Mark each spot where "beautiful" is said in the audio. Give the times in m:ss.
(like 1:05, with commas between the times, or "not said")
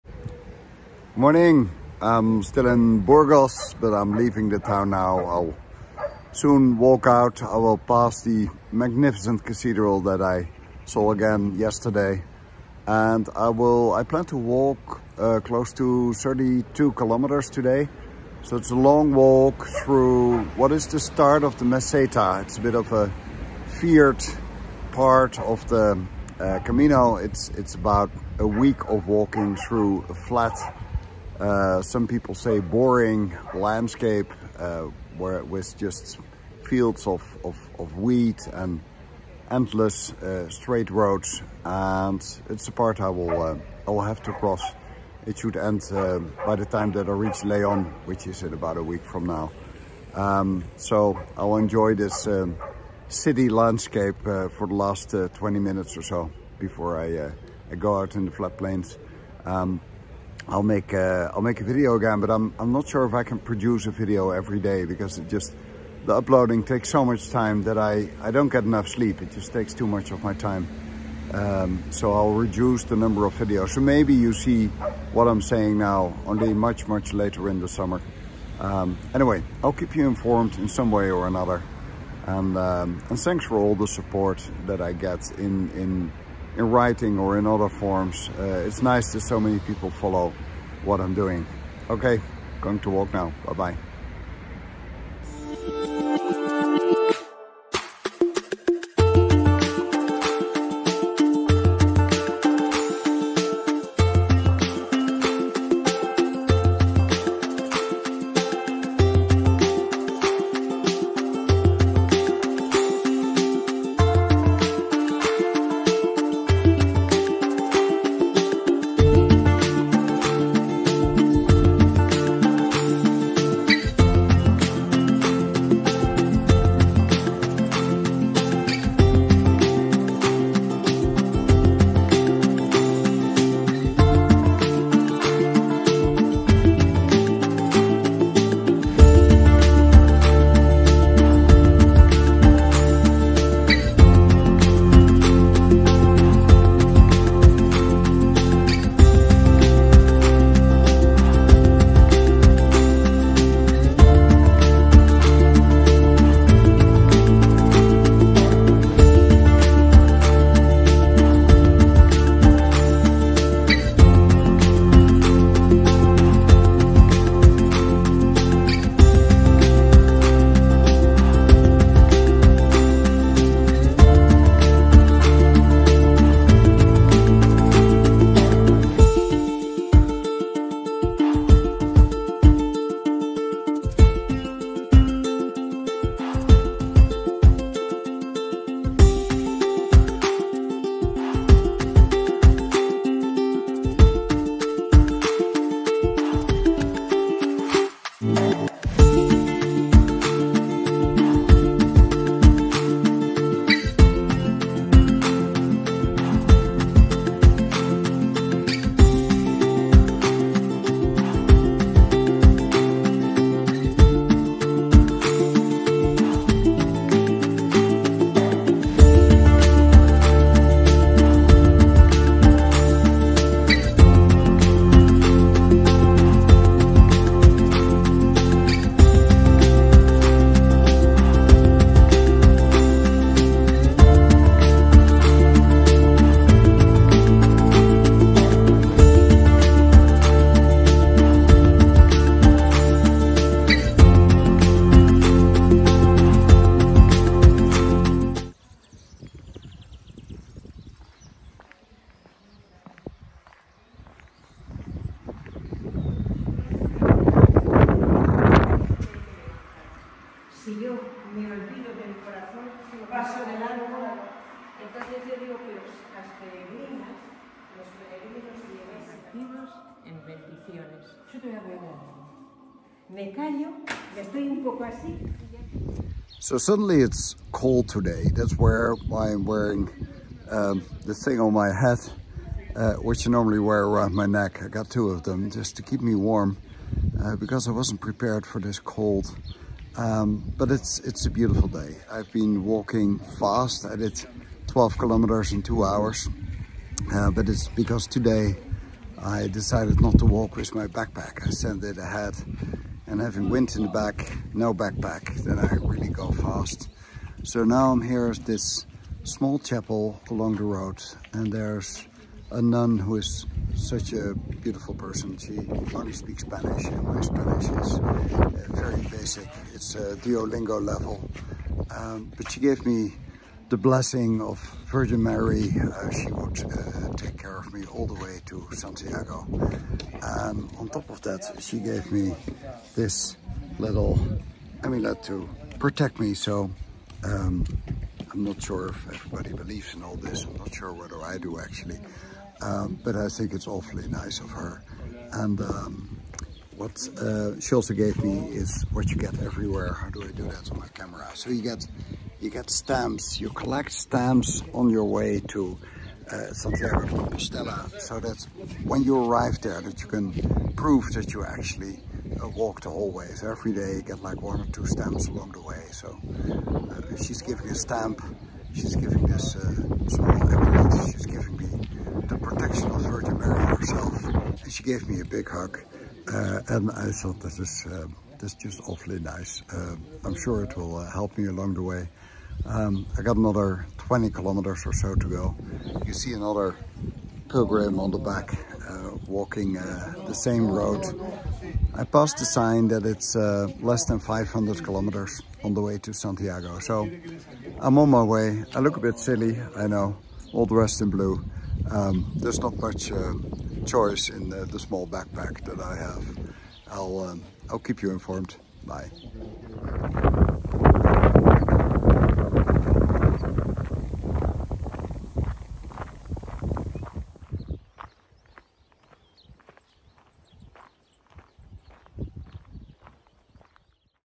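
4:51, 5:14.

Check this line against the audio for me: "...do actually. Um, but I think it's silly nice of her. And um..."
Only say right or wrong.
wrong.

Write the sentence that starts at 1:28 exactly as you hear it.
Uh, it's nice that so many people follow what I'm doing.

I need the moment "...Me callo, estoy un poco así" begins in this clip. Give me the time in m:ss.
4:33.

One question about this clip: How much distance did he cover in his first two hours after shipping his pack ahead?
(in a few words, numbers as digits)
12 kilometers.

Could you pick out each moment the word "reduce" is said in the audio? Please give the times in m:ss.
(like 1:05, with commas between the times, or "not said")
1:12.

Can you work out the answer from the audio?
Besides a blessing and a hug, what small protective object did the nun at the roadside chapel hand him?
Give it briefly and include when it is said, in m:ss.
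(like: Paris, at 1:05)
amulet, at 5:34.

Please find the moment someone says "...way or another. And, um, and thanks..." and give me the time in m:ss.
1:20.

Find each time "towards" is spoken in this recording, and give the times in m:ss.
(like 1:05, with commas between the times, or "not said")
not said.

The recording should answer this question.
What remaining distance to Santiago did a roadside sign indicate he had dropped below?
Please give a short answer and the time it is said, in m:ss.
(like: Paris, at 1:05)
500 kilometers, at 6:34.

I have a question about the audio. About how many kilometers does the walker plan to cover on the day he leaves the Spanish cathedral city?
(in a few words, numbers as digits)
32.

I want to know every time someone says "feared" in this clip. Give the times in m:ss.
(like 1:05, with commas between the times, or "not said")
0:23.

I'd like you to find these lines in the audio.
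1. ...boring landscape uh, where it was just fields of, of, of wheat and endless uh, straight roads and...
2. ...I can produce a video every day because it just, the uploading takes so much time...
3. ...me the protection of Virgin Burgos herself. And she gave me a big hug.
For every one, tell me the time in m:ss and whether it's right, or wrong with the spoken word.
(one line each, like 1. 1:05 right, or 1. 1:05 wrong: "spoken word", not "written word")
1. 0:32 right
2. 1:03 right
3. 6:11 wrong: "Mary", not "Burgos".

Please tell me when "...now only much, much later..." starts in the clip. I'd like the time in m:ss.
1:15.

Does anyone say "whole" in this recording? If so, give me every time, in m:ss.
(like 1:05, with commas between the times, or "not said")
6:02.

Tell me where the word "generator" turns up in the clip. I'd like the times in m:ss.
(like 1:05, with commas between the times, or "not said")
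not said.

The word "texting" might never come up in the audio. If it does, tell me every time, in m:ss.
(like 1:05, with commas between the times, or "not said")
not said.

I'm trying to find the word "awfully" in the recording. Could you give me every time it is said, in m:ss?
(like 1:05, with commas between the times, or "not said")
5:43, 6:18.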